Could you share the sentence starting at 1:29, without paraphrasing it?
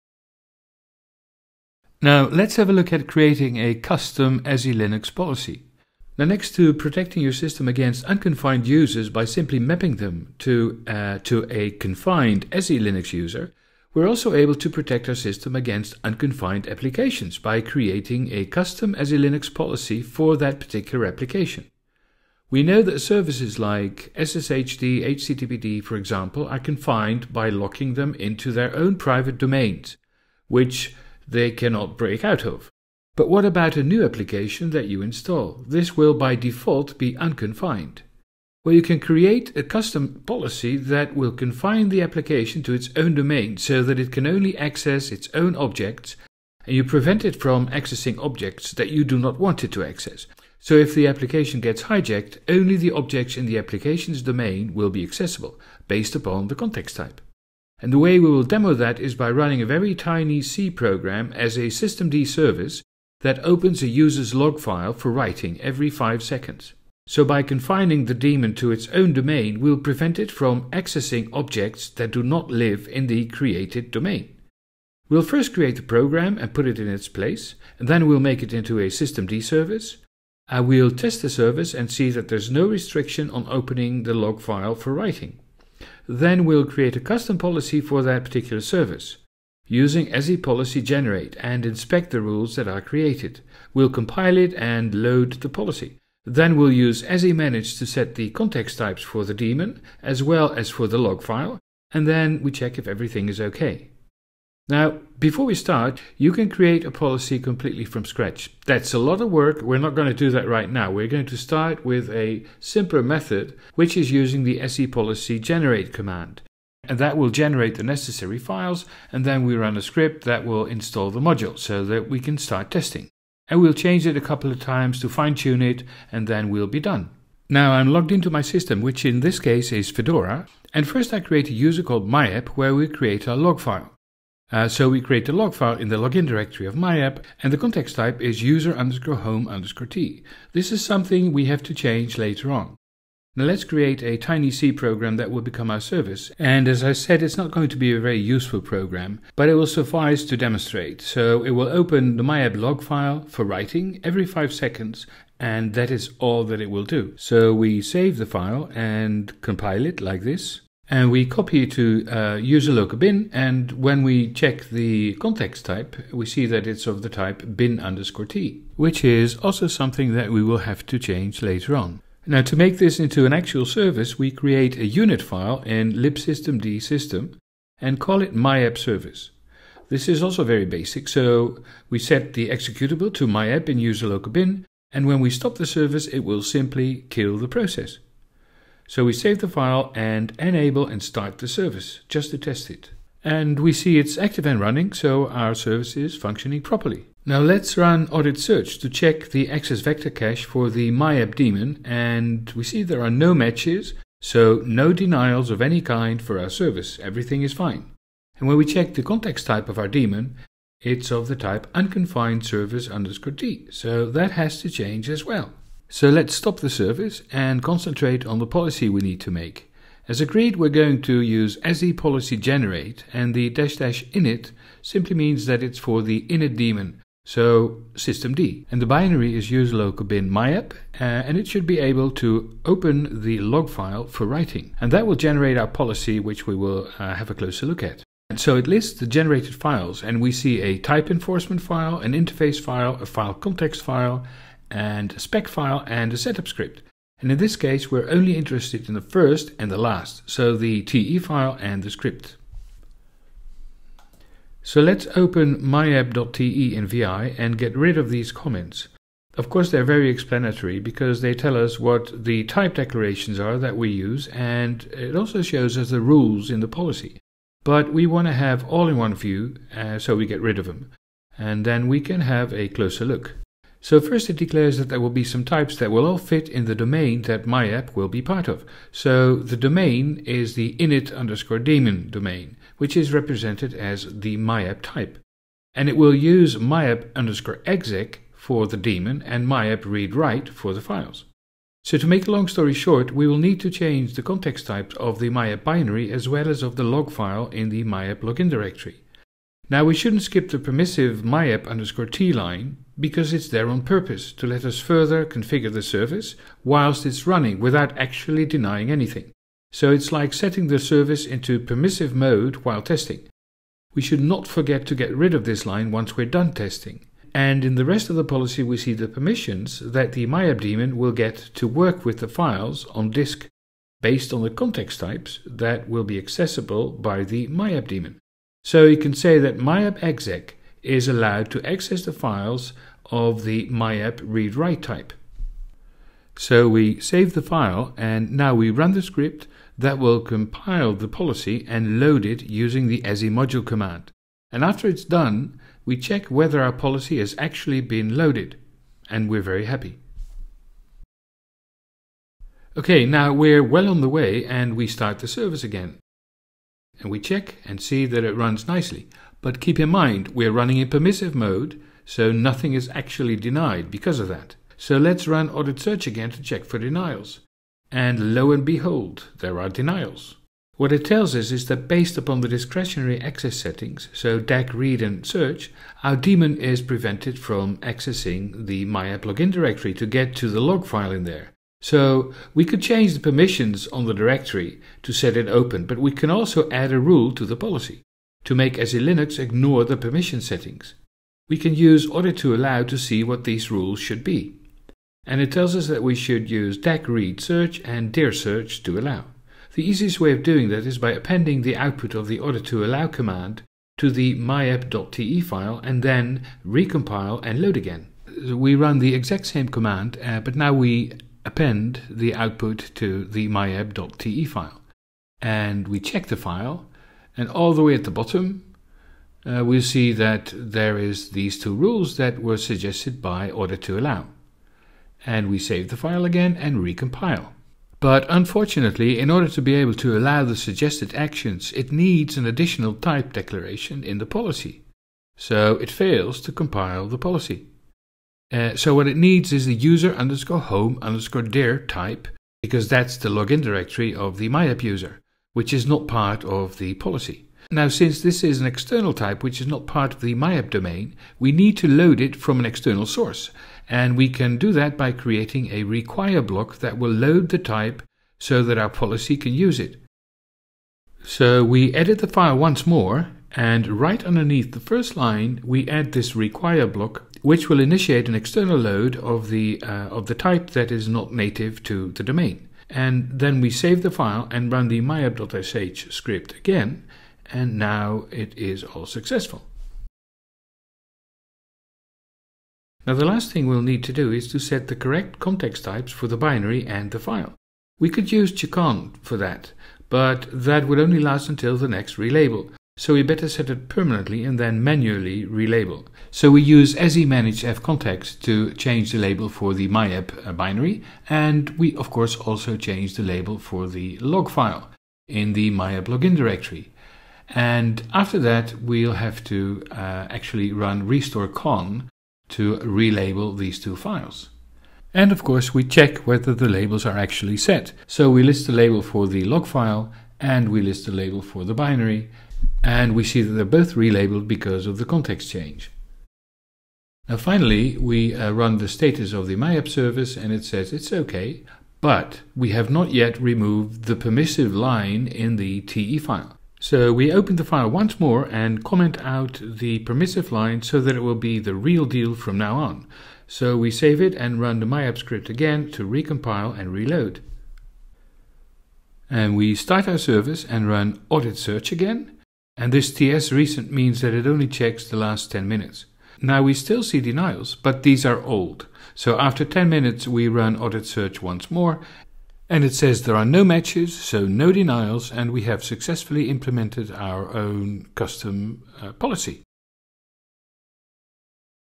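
Using sepolicy generate and inspect the rules that are created.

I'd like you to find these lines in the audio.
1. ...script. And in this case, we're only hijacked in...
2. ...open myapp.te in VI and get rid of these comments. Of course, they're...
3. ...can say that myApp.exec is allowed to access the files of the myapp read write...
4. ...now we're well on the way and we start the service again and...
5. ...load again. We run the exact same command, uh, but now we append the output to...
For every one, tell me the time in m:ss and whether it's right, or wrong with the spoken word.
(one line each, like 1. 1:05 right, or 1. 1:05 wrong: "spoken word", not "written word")
1. 4:06 wrong: "interested", not "hijacked"
2. 4:15 right
3. 5:28 right
4. 5:53 right
5. 6:47 right.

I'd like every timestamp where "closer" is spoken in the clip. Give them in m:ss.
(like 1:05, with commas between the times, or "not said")
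3:57, 4:32.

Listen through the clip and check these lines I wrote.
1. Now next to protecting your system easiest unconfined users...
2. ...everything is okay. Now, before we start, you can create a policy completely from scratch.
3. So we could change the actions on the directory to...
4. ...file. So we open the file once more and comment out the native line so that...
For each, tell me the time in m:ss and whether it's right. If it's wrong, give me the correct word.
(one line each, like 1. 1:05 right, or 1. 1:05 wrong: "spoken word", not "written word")
1. 0:06 wrong: "against", not "easiest"
2. 1:42 right
3. 6:21 wrong: "permissions", not "actions"
4. 8:56 wrong: "permissive", not "native".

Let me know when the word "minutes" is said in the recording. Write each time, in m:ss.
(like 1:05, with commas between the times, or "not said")
9:15, 9:19.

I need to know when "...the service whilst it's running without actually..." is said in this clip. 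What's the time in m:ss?
5:05.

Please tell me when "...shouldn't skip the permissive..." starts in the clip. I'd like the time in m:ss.
4:59.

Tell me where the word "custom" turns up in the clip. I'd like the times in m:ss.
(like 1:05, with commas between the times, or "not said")
0:03, 0:18, 0:39, 1:26, 9:28.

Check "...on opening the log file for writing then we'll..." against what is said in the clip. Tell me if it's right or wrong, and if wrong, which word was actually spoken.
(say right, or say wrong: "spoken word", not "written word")
right.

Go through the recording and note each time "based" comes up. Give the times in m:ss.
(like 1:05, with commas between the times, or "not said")
0:55, 5:24, 6:11.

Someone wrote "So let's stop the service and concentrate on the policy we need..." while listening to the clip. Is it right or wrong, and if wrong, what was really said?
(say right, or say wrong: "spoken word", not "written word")
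right.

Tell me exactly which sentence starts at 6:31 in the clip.
We can use audit2allow to see what these rules should be.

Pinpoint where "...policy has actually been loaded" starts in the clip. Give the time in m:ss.
5:46.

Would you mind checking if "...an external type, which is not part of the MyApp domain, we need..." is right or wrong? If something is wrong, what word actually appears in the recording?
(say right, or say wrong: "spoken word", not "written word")
right.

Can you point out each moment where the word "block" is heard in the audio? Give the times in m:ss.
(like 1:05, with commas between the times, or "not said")
7:36, 7:46.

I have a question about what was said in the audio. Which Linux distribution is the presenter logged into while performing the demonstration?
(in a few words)
Fedora.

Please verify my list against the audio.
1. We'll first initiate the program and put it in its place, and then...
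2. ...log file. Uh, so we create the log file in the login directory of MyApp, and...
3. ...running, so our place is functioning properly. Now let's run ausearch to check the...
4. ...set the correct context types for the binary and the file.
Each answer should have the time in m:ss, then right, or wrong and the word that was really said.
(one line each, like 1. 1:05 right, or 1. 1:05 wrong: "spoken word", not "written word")
1. 1:15 wrong: "create", not "initiate"
2. 2:13 right
3. 3:14 wrong: "service", not "place"
4. 8:04 right.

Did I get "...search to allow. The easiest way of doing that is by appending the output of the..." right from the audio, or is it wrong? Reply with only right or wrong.
right.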